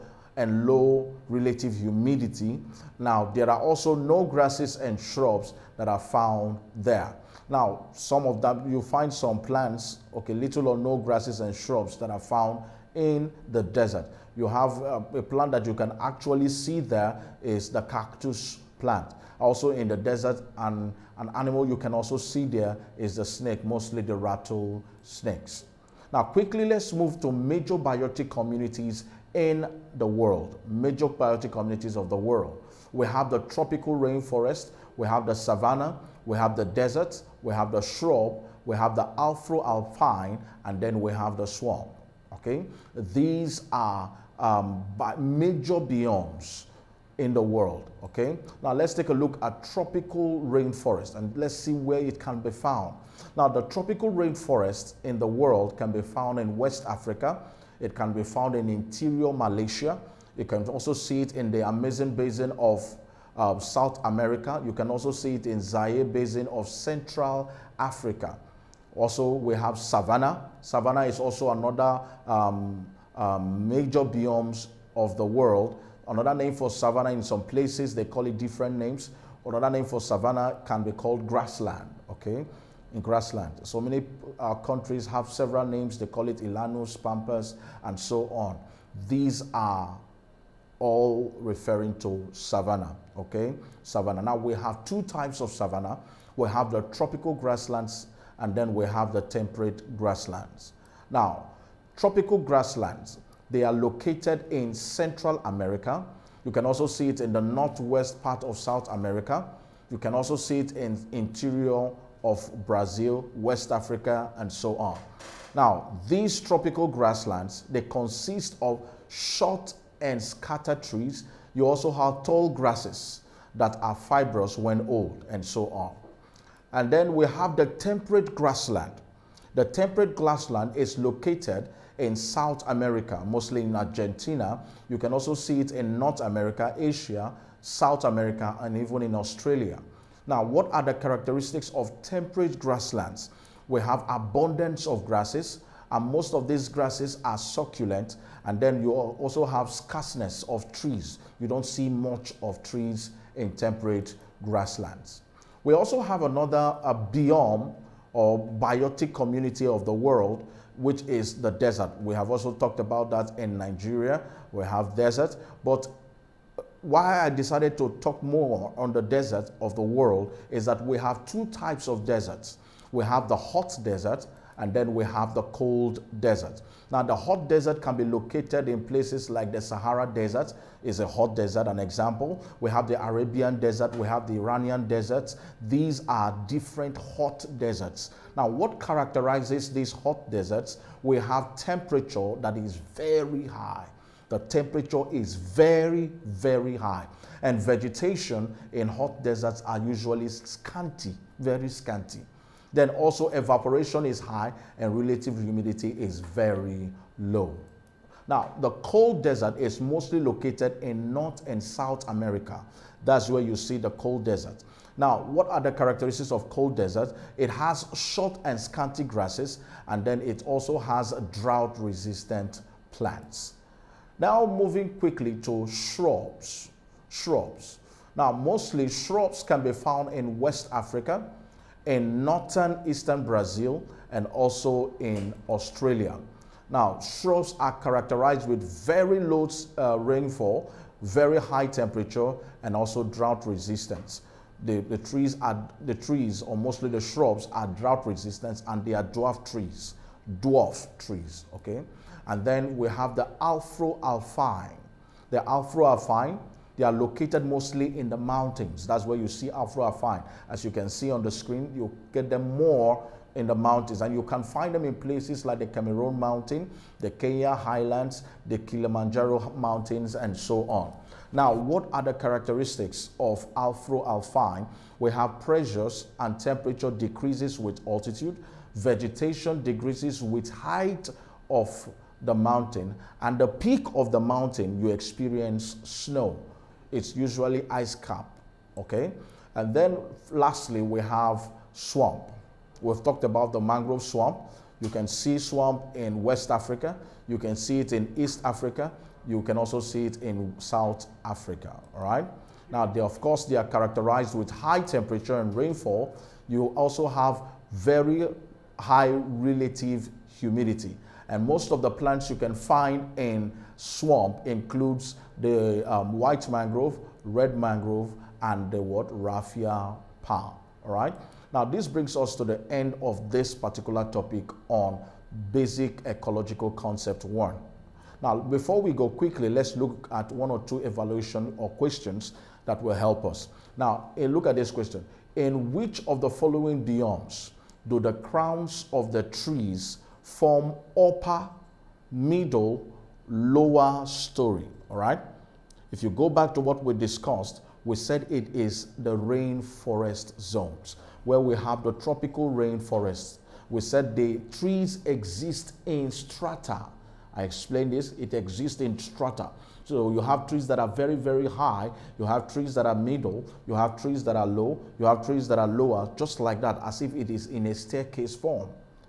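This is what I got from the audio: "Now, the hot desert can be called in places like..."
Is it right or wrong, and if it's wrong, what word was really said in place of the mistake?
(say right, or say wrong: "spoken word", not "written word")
wrong: "located", not "called".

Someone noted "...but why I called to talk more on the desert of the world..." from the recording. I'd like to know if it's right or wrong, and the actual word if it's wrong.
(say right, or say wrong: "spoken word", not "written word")
wrong: "decided", not "called".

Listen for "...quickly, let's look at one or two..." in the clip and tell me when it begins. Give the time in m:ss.
5:29.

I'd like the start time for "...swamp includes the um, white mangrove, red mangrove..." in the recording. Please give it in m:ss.
5:13.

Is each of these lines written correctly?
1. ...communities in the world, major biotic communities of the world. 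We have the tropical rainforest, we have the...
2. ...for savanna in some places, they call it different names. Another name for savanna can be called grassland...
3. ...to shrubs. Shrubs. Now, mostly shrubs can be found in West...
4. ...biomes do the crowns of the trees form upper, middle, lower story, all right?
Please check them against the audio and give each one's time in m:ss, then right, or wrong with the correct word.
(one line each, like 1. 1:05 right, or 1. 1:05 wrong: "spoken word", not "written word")
1. 0:28 right
2. 1:16 right
3. 3:45 right
4. 5:36 right.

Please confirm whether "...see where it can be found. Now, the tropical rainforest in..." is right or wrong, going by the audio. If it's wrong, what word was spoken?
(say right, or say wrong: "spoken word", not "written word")
right.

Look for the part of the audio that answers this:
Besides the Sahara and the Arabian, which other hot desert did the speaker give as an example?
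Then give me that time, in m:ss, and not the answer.
3:04.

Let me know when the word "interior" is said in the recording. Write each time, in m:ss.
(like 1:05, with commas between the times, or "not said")
0:58, 1:51.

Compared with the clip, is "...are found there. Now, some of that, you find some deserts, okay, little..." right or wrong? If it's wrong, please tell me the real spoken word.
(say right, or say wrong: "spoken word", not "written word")
wrong: "plants", not "deserts".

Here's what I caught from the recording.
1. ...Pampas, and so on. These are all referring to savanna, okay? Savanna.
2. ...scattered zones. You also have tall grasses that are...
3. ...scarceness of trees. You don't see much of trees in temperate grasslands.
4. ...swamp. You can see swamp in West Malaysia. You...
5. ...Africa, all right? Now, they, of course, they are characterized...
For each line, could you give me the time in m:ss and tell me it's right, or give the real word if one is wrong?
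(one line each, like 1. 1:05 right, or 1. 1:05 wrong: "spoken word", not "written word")
1. 1:27 right
2. 2:00 wrong: "trees", not "zones"
3. 2:29 right
4. 4:54 wrong: "Africa", not "Malaysia"
5. 5:01 right.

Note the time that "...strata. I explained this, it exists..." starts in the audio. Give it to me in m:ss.
5:56.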